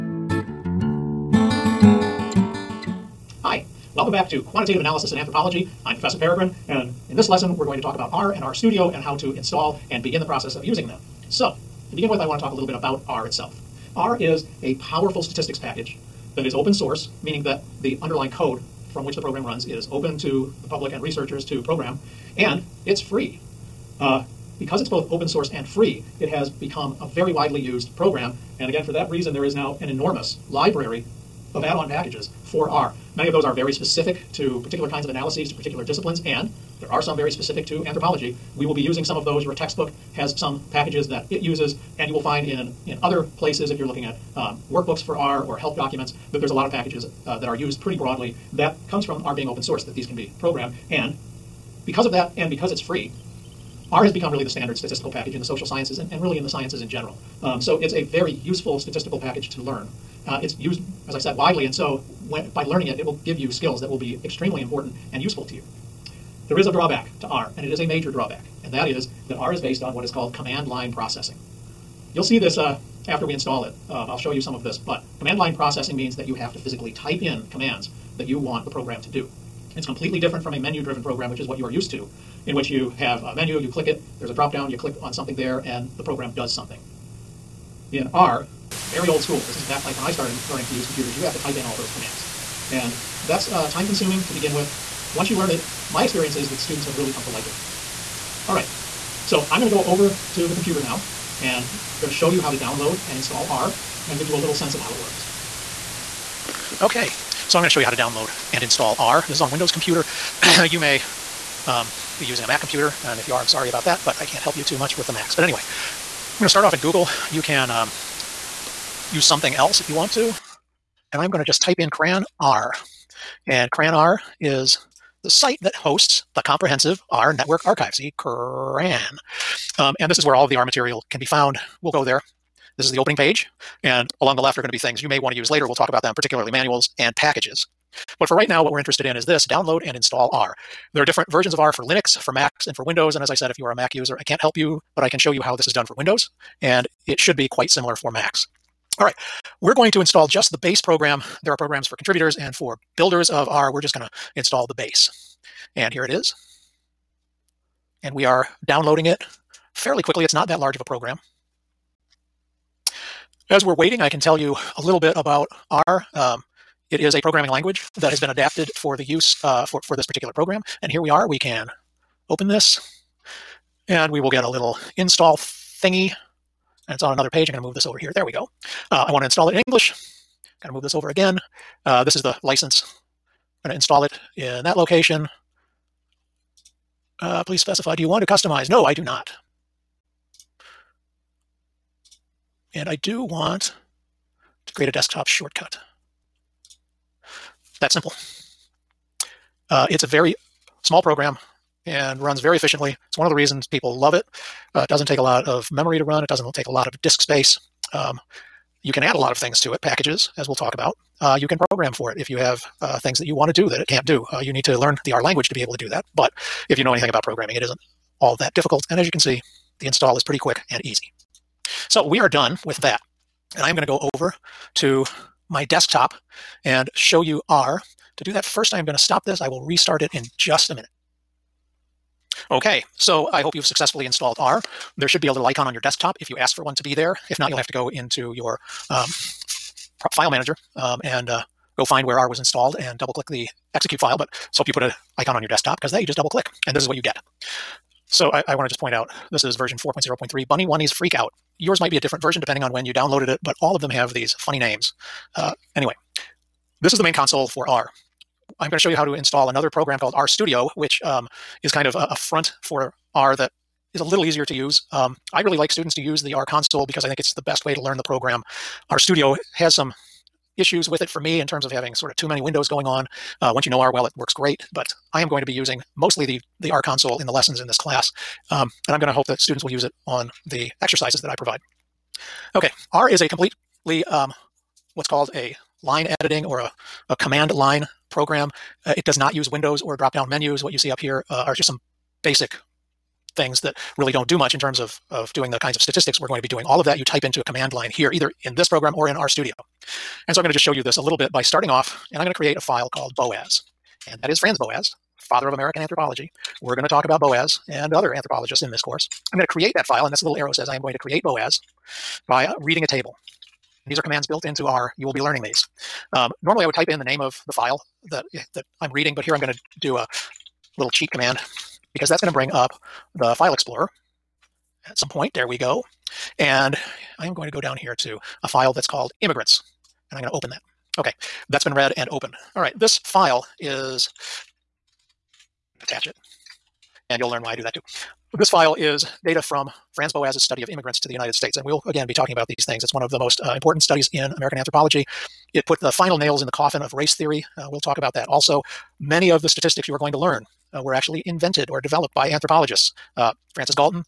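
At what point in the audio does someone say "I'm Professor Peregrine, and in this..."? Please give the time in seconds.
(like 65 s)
5 s.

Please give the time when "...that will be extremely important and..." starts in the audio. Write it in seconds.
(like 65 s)
63 s.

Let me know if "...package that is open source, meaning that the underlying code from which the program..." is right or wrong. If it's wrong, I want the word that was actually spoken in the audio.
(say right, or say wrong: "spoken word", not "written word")
right.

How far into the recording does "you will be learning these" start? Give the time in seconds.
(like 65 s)
314 s.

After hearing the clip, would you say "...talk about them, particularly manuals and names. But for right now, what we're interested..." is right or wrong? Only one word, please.
wrong.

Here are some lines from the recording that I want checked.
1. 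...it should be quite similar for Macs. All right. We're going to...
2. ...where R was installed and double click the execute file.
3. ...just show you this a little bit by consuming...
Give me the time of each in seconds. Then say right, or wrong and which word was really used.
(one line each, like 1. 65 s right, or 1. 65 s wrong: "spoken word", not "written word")
1. 147 s right
2. 242 s right
3. 300 s wrong: "starting", not "consuming".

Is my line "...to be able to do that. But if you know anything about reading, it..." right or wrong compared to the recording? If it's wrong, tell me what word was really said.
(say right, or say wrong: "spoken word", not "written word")
wrong: "programming", not "reading".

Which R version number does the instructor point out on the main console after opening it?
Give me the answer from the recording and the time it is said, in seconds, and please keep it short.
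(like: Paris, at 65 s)
4.0.3, at 249 s.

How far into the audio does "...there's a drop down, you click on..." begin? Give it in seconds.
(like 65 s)
84 s.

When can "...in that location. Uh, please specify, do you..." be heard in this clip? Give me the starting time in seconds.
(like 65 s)
184 s.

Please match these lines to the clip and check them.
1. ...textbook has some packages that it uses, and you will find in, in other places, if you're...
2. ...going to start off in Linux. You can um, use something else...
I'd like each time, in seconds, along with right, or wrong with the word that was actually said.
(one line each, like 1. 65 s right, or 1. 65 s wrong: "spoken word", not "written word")
1. 39 s right
2. 116 s wrong: "Google", not "Linux".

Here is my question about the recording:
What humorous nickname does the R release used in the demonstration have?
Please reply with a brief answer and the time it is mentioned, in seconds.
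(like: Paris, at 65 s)
Bunny-Wunnies Freak Out, at 250 s.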